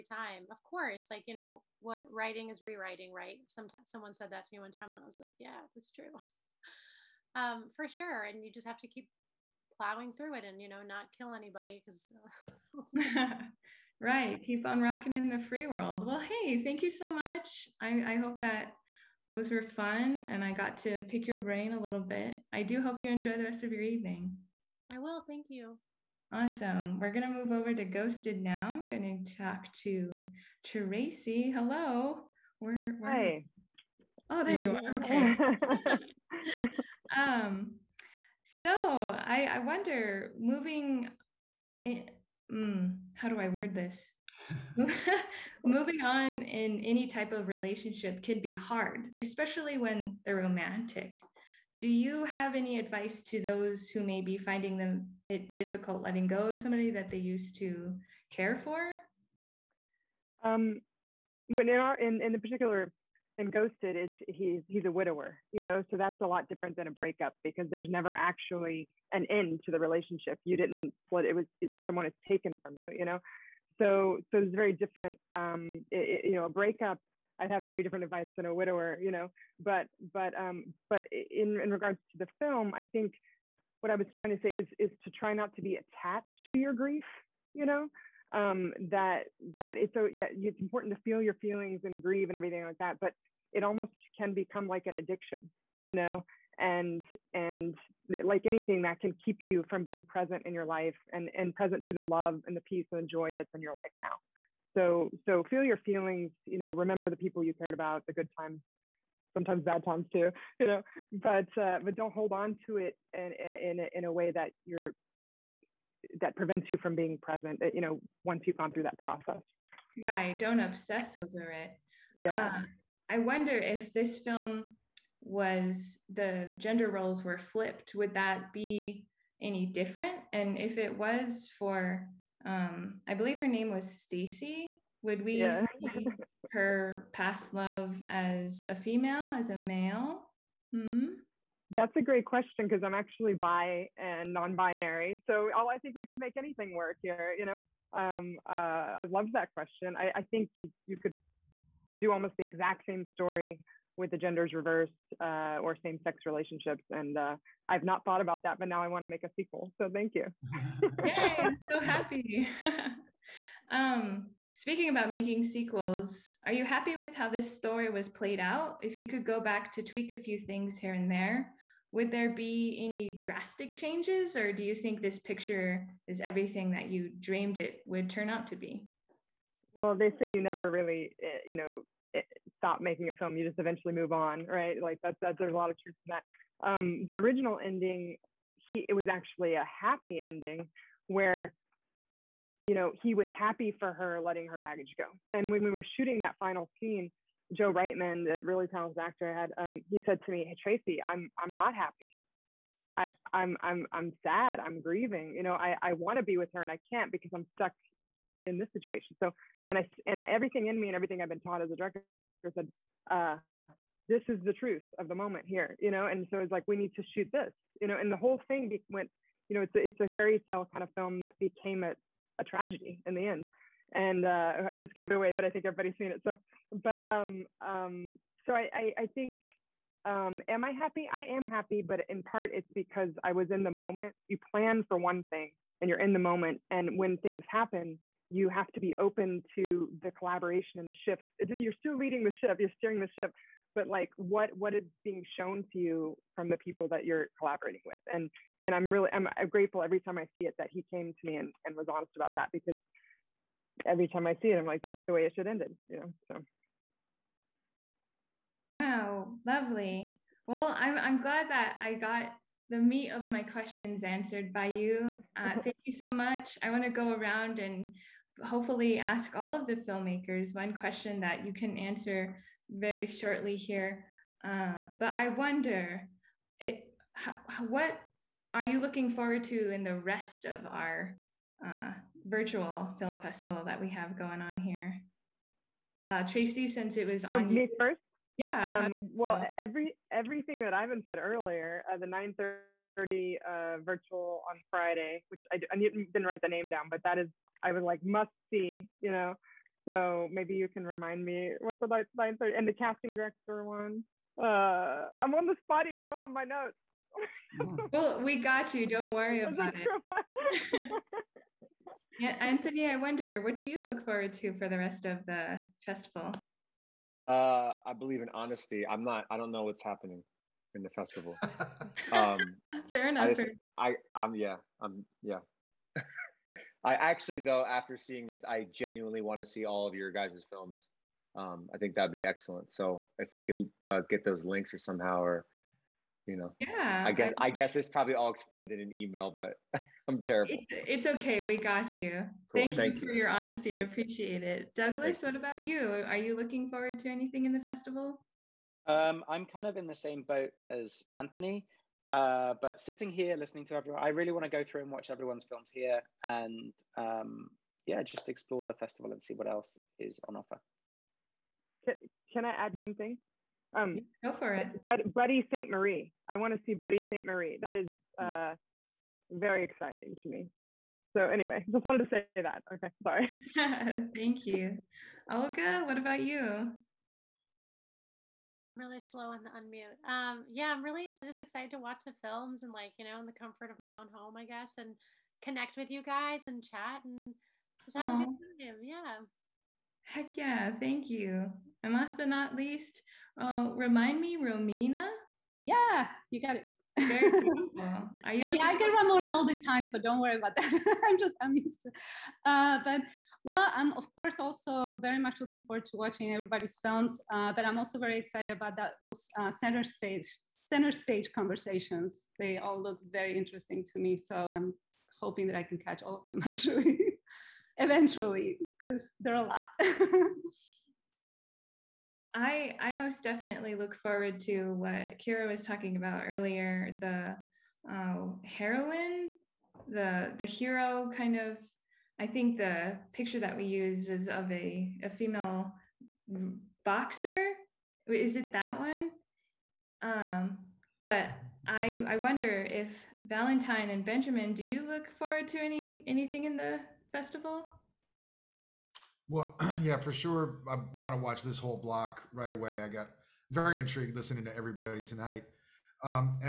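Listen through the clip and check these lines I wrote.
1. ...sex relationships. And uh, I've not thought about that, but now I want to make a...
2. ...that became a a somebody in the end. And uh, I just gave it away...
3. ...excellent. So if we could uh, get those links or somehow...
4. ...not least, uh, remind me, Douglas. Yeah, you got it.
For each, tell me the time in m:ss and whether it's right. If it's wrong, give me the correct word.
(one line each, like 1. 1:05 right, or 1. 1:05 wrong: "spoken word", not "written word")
1. 2:36 right
2. 3:41 wrong: "tragedy", not "somebody"
3. 5:32 right
4. 6:32 wrong: "Romina", not "Douglas".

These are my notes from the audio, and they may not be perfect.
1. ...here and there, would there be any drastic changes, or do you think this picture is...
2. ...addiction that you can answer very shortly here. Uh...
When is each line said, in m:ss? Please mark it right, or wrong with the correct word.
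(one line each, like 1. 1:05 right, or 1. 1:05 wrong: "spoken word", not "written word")
1. 2:50 right
2. 4:30 wrong: "question", not "addiction".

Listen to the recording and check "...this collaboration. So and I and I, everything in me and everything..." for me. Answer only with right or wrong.
wrong.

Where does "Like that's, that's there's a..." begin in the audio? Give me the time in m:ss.
3:04.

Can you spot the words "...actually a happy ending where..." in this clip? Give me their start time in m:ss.
3:09.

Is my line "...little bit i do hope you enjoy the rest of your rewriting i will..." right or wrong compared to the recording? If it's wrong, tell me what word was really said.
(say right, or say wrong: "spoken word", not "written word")
wrong: "evening", not "rewriting".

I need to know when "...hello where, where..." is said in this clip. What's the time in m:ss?
0:31.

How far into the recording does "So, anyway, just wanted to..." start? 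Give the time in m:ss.
6:11.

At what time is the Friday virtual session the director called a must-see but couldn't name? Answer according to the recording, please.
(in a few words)
9:30.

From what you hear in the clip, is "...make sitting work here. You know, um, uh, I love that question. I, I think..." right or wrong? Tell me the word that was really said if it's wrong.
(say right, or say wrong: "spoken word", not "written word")
wrong: "anything", not "sitting".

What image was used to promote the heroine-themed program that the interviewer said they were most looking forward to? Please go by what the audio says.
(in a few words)
A female boxer.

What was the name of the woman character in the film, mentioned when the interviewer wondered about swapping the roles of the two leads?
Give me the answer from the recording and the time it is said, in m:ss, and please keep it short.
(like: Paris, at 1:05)
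Stacy, at 2:14.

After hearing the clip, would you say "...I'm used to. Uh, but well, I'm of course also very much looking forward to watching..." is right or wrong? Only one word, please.
right.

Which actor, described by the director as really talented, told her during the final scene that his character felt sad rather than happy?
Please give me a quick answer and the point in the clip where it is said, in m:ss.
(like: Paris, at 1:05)
Joe Reitman, at 3:17.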